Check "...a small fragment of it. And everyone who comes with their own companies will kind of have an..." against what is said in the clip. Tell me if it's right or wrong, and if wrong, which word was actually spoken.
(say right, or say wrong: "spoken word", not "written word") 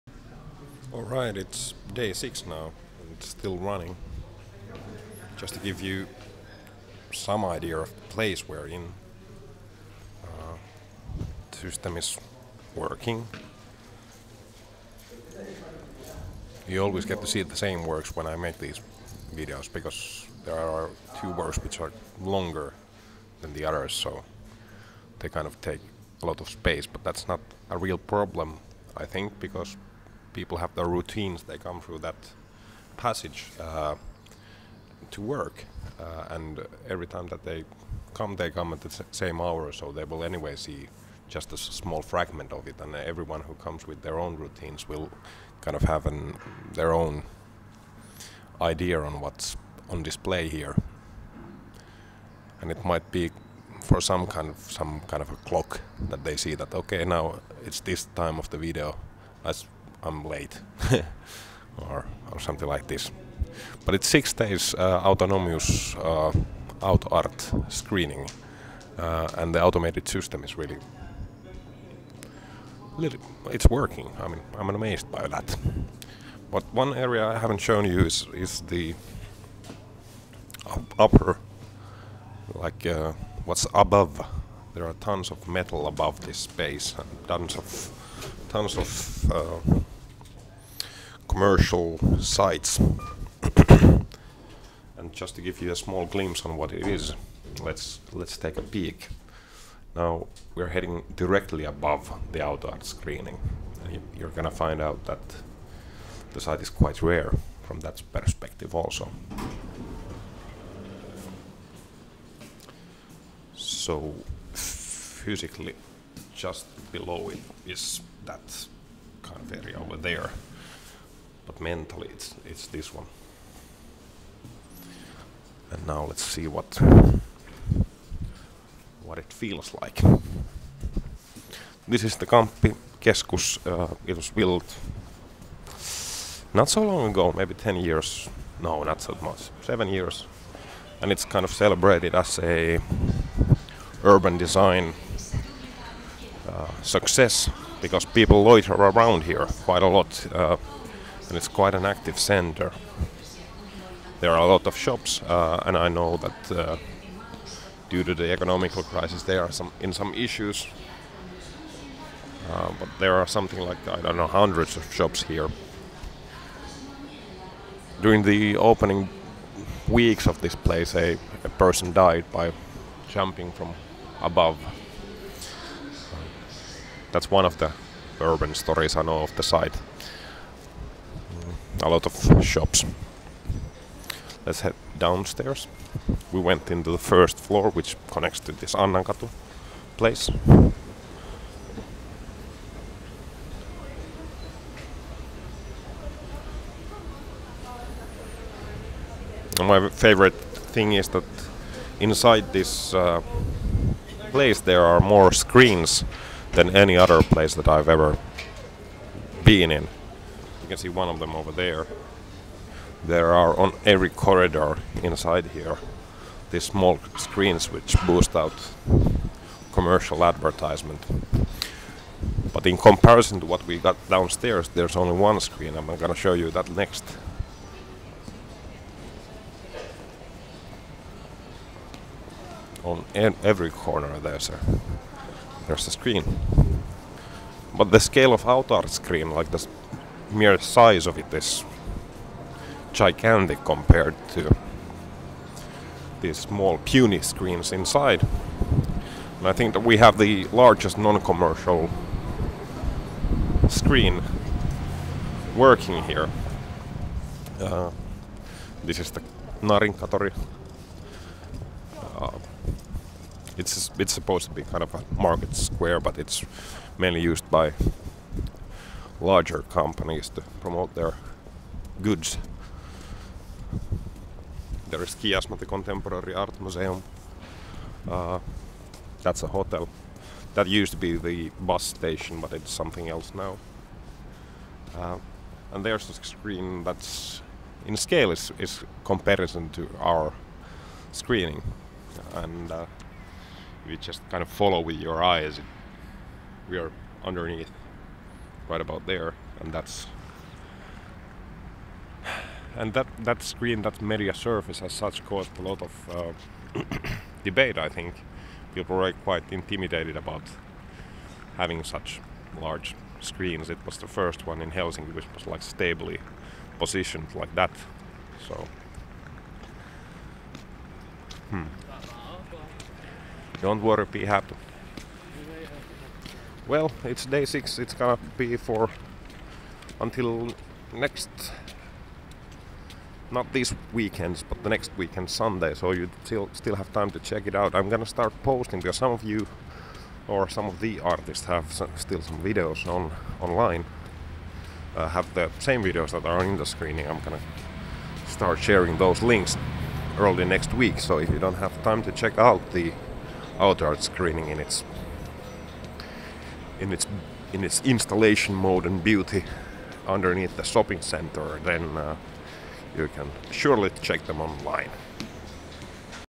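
wrong: "routines", not "companies".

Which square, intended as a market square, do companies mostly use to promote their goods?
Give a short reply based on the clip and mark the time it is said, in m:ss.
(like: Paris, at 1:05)
Narinkkatori, at 4:19.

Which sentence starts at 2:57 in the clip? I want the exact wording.
That's one of the urban stories I know of the site a lot of shops.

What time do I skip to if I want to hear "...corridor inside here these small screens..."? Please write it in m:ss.
3:34.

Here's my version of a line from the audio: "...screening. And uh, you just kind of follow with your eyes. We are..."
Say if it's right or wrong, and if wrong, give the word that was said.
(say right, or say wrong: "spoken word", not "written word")
right.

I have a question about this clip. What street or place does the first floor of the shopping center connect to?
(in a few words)
Annankatu.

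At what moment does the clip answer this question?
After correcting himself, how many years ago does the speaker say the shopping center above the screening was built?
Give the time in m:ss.
2:19.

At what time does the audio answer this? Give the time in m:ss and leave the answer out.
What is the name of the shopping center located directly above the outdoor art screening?
2:12.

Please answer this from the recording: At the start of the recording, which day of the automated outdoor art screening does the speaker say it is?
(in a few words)
Day 6.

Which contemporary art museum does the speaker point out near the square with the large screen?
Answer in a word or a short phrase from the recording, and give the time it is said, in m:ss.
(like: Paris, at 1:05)
Kiasma, at 4:35.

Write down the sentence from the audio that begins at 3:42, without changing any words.
But in comparison to what we got downstairs, there's only one screen.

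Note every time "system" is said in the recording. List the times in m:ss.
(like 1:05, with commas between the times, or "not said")
0:11, 1:10.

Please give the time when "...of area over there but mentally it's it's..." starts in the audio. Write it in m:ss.
1:59.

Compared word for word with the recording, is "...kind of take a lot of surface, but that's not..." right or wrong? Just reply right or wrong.
wrong.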